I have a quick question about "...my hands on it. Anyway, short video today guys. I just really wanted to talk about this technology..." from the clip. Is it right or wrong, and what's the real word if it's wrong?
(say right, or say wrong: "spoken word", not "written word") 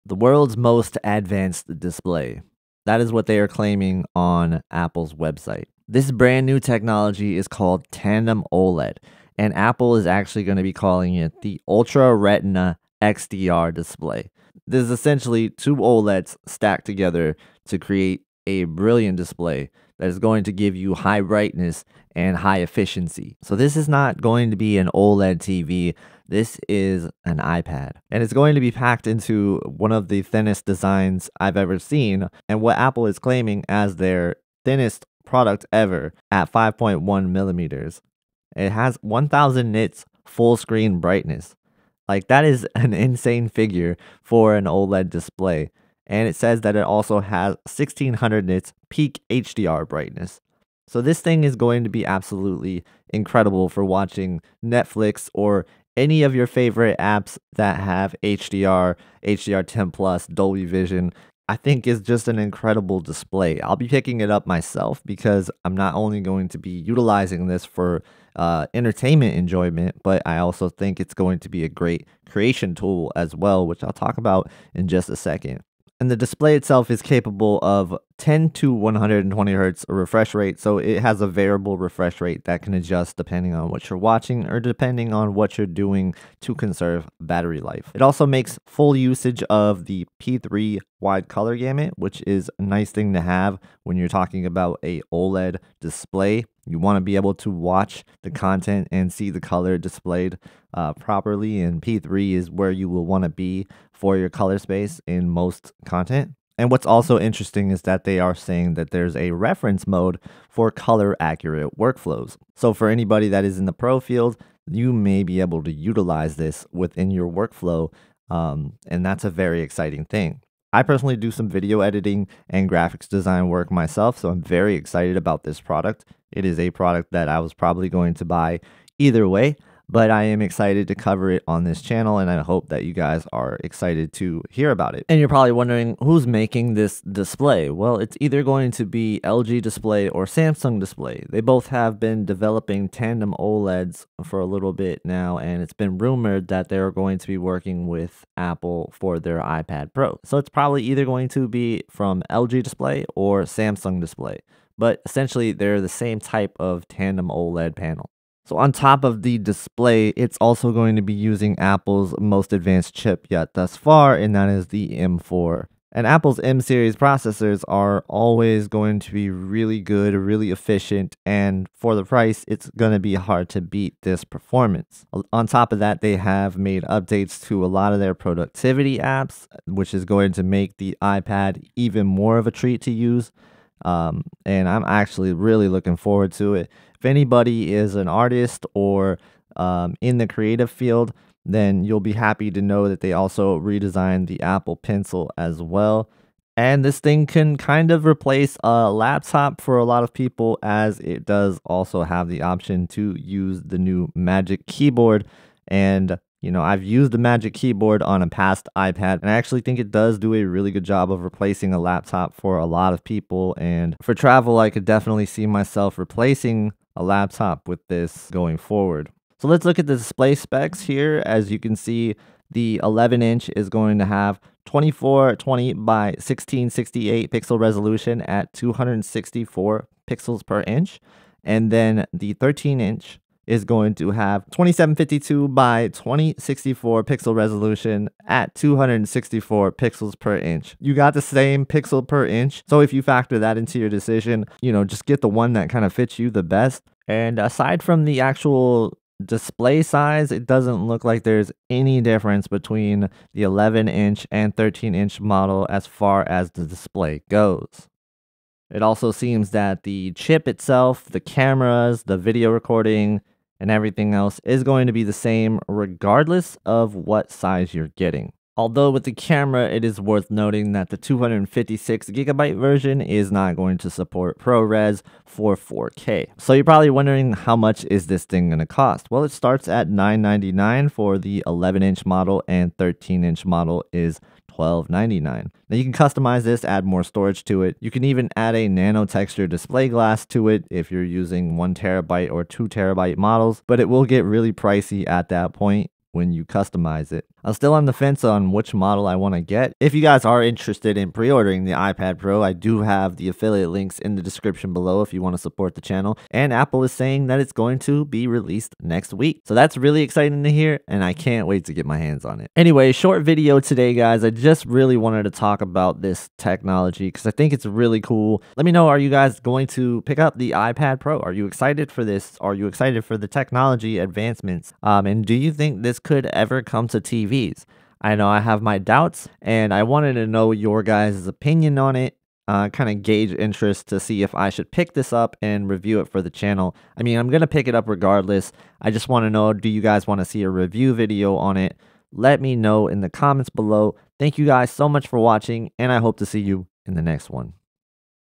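right.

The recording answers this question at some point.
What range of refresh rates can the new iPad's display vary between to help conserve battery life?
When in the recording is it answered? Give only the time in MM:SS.
01:18.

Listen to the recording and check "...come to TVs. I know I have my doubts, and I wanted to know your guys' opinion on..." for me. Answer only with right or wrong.
right.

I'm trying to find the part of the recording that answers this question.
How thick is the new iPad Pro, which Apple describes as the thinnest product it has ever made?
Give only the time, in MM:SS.
00:36.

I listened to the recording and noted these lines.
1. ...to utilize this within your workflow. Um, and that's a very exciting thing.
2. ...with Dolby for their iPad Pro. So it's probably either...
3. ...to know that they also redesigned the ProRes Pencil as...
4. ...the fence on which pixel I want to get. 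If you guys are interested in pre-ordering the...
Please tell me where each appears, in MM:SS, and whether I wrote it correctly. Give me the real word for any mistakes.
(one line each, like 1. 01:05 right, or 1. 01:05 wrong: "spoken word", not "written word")
1. 01:55 right
2. 02:27 wrong: "Apple", not "Dolby"
3. 03:12 wrong: "Apple", not "ProRes"
4. 04:57 wrong: "model", not "pixel".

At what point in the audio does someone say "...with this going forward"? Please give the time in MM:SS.
03:37.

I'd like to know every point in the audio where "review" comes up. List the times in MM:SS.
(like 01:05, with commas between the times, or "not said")
05:35, 05:40.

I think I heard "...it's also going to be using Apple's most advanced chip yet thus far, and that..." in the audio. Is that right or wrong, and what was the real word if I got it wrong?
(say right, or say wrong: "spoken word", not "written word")
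right.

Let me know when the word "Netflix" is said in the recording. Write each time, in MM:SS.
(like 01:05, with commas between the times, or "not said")
00:54.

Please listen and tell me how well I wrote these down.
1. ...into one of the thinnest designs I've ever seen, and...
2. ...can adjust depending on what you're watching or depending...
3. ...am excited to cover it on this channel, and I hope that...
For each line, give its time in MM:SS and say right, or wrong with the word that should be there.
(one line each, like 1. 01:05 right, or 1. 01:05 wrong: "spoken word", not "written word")
1. 00:29 right
2. 01:22 right
3. 02:10 right.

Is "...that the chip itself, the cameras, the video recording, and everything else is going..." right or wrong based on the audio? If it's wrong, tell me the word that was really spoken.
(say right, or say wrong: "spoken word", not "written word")
right.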